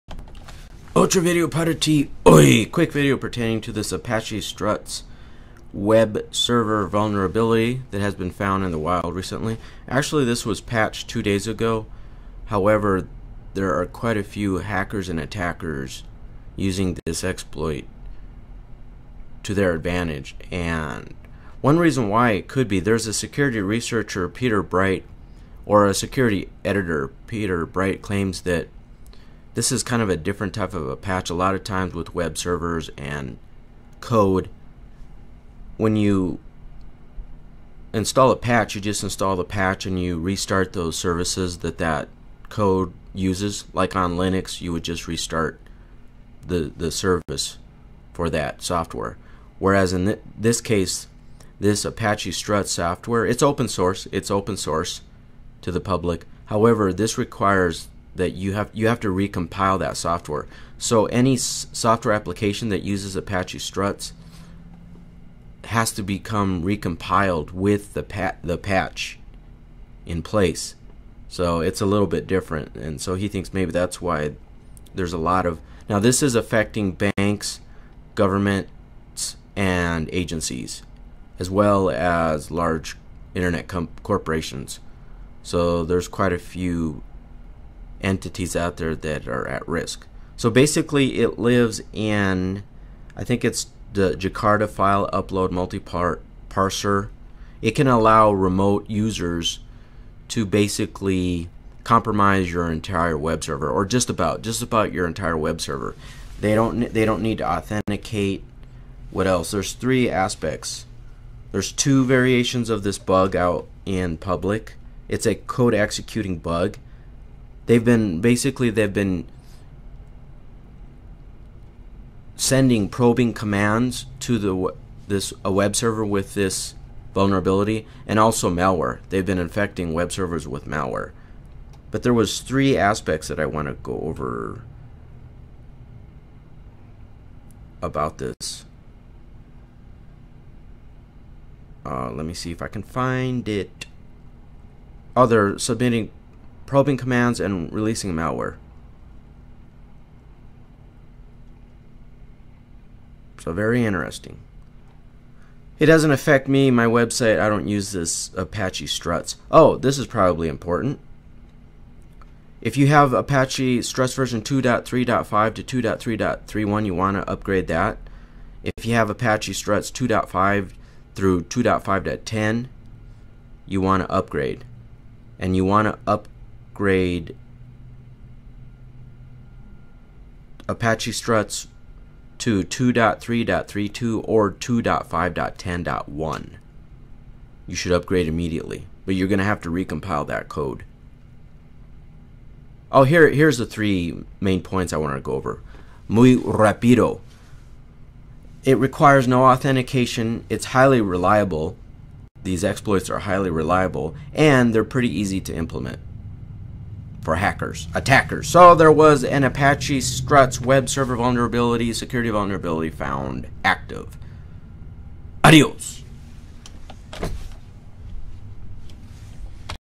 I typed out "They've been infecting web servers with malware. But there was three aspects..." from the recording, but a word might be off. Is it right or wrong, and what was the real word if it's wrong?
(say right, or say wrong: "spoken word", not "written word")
right.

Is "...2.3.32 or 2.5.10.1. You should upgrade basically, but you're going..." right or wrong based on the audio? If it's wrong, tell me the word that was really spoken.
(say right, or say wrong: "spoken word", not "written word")
wrong: "immediately", not "basically".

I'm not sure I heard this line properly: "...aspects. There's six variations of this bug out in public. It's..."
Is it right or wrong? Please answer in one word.
wrong.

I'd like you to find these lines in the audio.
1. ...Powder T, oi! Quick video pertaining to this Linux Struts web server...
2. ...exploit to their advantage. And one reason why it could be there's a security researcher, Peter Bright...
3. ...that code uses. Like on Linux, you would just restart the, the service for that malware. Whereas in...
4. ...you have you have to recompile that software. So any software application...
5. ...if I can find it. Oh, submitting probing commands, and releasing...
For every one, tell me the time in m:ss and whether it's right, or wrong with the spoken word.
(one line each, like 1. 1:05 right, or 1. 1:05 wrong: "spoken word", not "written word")
1. 0:01 wrong: "Apache", not "Linux"
2. 0:17 right
3. 0:41 wrong: "software", not "malware"
4. 0:58 right
5. 2:22 right.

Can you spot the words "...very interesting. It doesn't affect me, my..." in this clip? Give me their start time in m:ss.
2:33.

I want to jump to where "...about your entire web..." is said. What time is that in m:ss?
1:44.